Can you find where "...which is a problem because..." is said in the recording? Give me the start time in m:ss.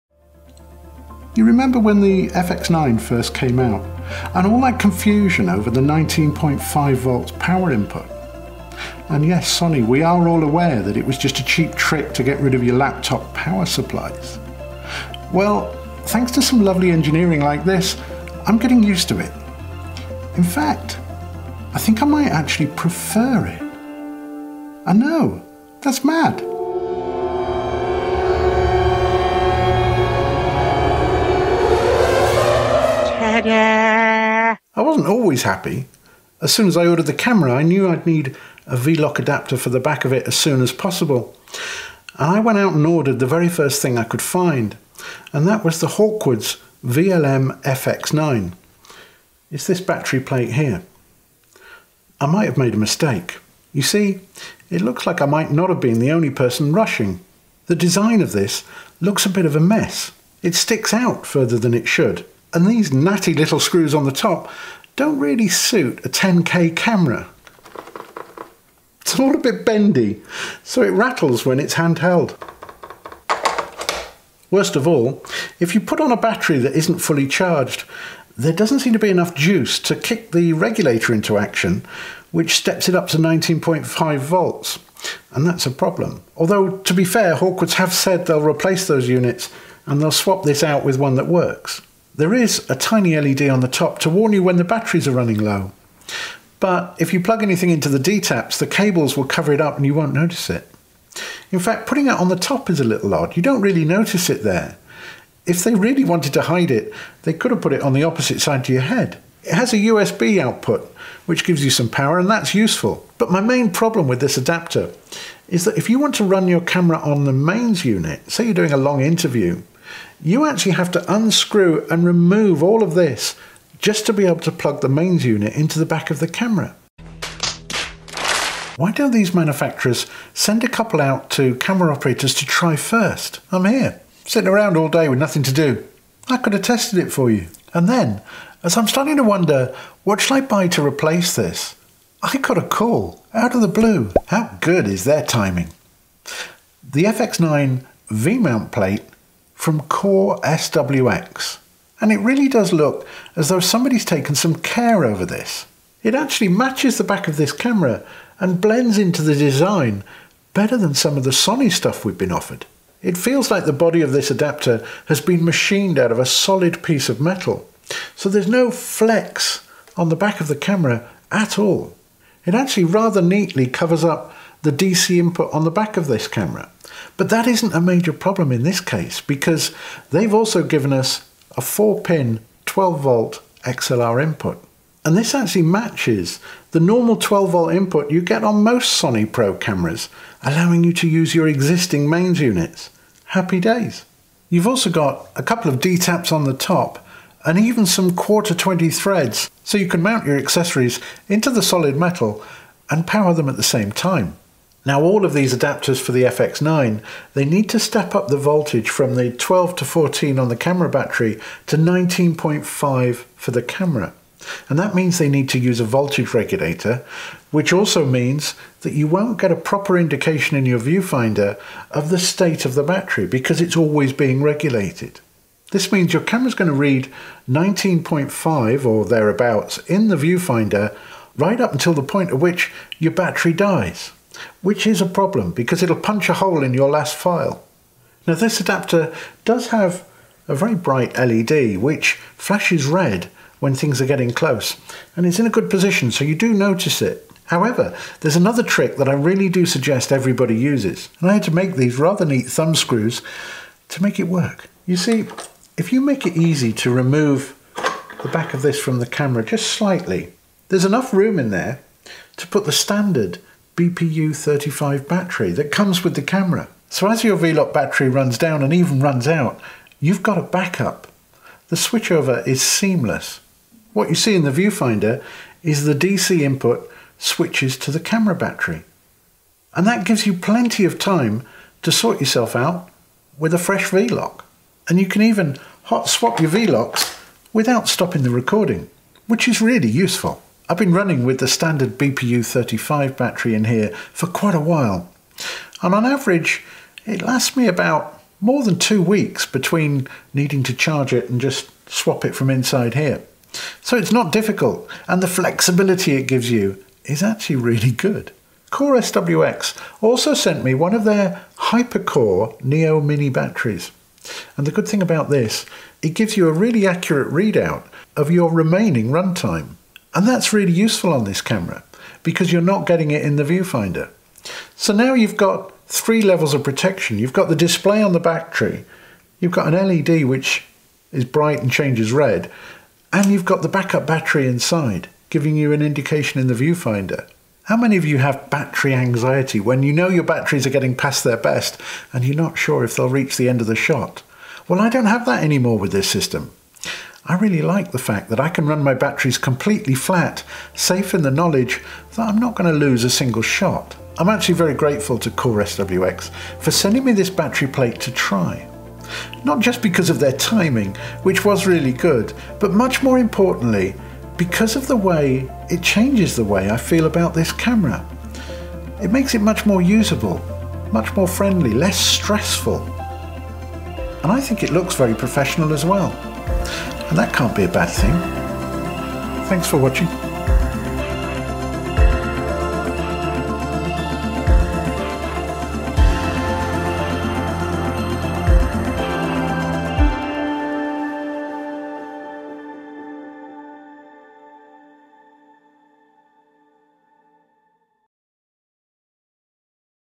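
3:54.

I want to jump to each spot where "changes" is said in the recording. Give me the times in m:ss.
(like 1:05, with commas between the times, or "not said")
5:31, 6:05.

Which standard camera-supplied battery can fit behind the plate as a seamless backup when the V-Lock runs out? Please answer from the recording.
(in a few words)
BPU35.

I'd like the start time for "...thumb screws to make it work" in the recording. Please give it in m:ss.
4:12.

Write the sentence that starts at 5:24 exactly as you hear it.
So now you've got three levels of protection.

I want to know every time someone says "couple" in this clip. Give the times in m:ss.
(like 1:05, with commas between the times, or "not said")
2:10, 3:15.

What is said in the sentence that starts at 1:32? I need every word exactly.
There is a tiny LED on the top to warn you when the batteries are running low.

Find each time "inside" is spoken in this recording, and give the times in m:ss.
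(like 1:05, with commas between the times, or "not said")
5:02, 5:34.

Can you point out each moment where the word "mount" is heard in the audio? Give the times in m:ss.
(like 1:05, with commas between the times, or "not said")
2:28, 3:20.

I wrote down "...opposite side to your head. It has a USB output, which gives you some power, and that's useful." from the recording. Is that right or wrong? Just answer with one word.
right.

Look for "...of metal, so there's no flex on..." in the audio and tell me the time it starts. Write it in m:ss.
2:47.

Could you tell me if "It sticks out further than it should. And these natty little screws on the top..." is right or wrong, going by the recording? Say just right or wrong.
right.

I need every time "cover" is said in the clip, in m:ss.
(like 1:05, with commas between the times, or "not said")
1:39, 2:53.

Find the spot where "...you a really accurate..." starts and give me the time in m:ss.
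5:16.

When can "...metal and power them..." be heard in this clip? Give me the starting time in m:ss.
3:21.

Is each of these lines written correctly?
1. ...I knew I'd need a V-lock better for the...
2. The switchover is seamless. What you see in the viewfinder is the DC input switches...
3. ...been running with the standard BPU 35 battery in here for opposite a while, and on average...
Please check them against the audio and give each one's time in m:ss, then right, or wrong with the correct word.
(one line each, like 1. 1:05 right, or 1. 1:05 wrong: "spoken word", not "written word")
1. 0:37 wrong: "adapter", not "better"
2. 4:31 right
3. 4:50 wrong: "quite", not "opposite".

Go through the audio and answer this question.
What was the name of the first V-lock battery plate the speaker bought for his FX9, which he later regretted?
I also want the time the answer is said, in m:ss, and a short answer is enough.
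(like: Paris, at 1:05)
Hawkwoods VLM FX9, at 0:45.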